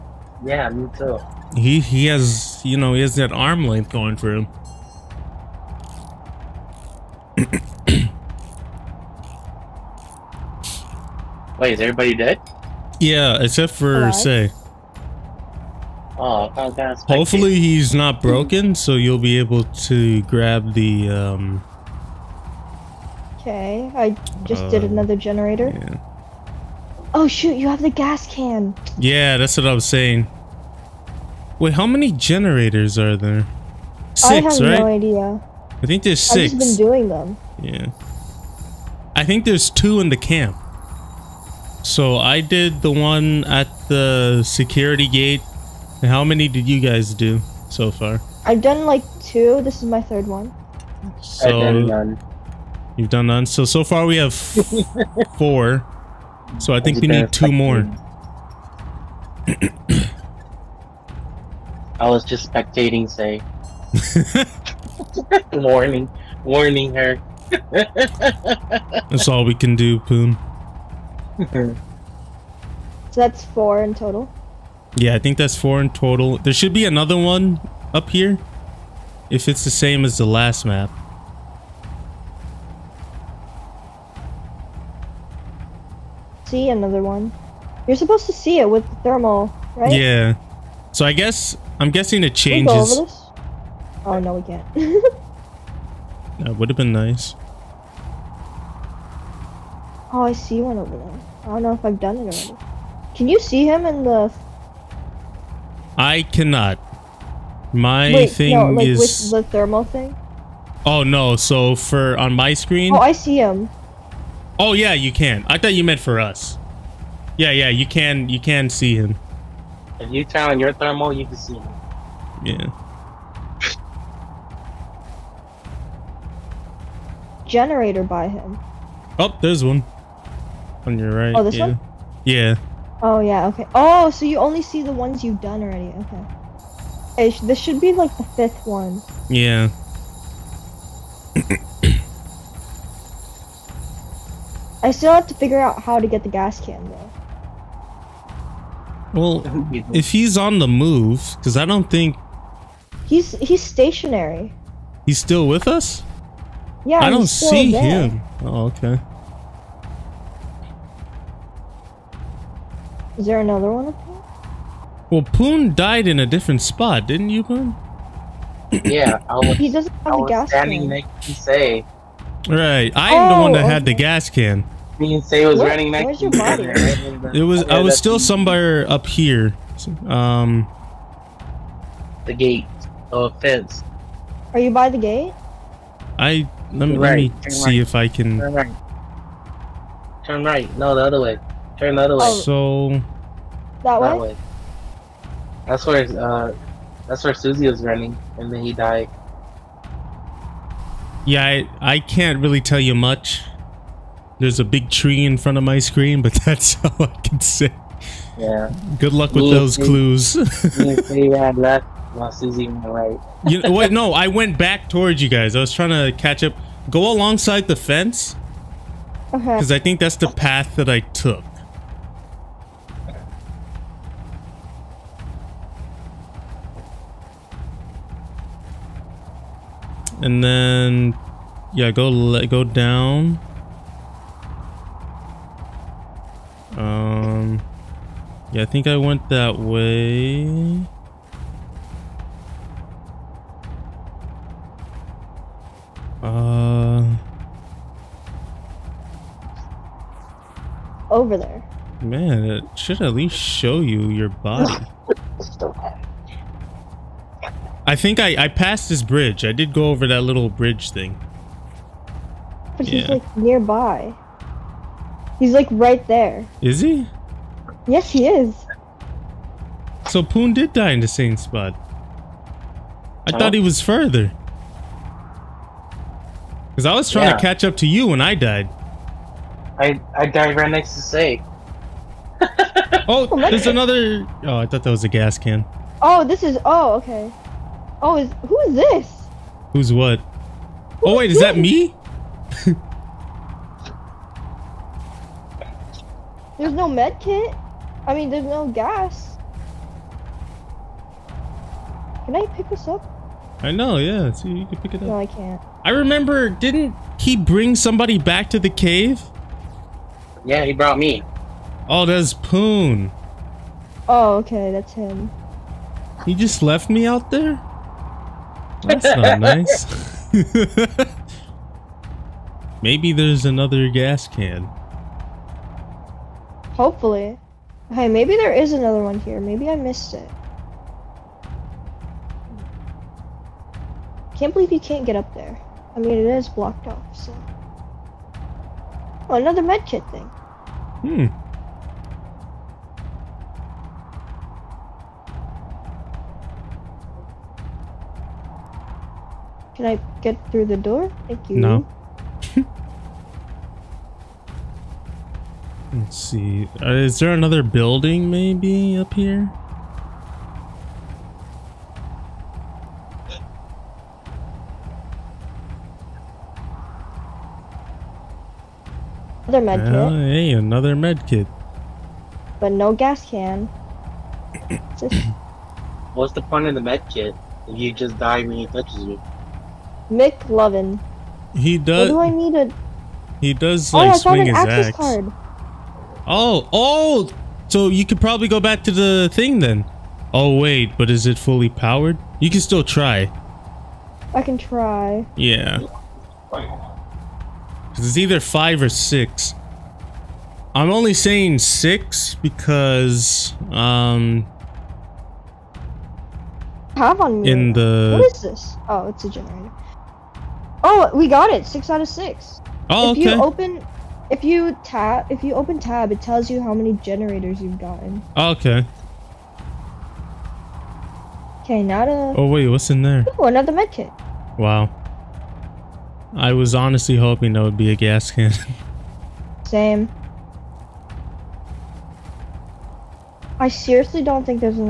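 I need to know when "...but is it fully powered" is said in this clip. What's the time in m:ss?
6:30.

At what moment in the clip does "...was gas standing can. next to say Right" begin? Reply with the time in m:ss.
2:50.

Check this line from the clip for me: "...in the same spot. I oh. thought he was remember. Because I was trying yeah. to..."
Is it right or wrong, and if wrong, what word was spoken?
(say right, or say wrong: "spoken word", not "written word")
wrong: "further", not "remember".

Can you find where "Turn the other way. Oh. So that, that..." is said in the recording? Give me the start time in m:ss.
3:11.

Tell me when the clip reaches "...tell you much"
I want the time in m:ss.
3:22.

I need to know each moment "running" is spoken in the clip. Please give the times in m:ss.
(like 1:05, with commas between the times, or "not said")
2:55, 3:17.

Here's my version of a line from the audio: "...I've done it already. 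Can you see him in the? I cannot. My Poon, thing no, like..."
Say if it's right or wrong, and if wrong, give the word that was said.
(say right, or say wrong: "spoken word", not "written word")
wrong: "Wait", not "Poon".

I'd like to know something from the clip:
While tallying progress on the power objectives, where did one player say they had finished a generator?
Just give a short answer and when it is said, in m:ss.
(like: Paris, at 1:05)
security gate, at 0:44.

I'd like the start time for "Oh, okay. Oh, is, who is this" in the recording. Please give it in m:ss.
4:46.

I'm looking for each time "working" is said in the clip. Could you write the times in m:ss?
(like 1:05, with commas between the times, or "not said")
not said.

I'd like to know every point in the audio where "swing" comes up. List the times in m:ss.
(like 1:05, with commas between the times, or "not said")
6:24.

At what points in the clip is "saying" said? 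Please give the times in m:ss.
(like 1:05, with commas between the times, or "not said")
0:29, 6:41.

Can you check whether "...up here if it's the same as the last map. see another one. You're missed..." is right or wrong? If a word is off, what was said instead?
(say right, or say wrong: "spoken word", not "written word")
wrong: "supposed", not "missed".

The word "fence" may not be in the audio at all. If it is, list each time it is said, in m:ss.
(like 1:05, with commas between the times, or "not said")
3:03, 3:37.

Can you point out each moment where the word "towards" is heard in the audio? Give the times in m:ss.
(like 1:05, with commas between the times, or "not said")
3:34.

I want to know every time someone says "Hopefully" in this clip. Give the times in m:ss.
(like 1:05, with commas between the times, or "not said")
0:17, 5:26.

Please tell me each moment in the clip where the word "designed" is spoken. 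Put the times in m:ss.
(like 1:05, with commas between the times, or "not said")
not said.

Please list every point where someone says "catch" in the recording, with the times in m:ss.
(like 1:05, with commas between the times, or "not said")
3:36, 4:37.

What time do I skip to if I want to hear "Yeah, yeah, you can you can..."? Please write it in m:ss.
1:57.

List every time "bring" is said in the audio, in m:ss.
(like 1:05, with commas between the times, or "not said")
5:07.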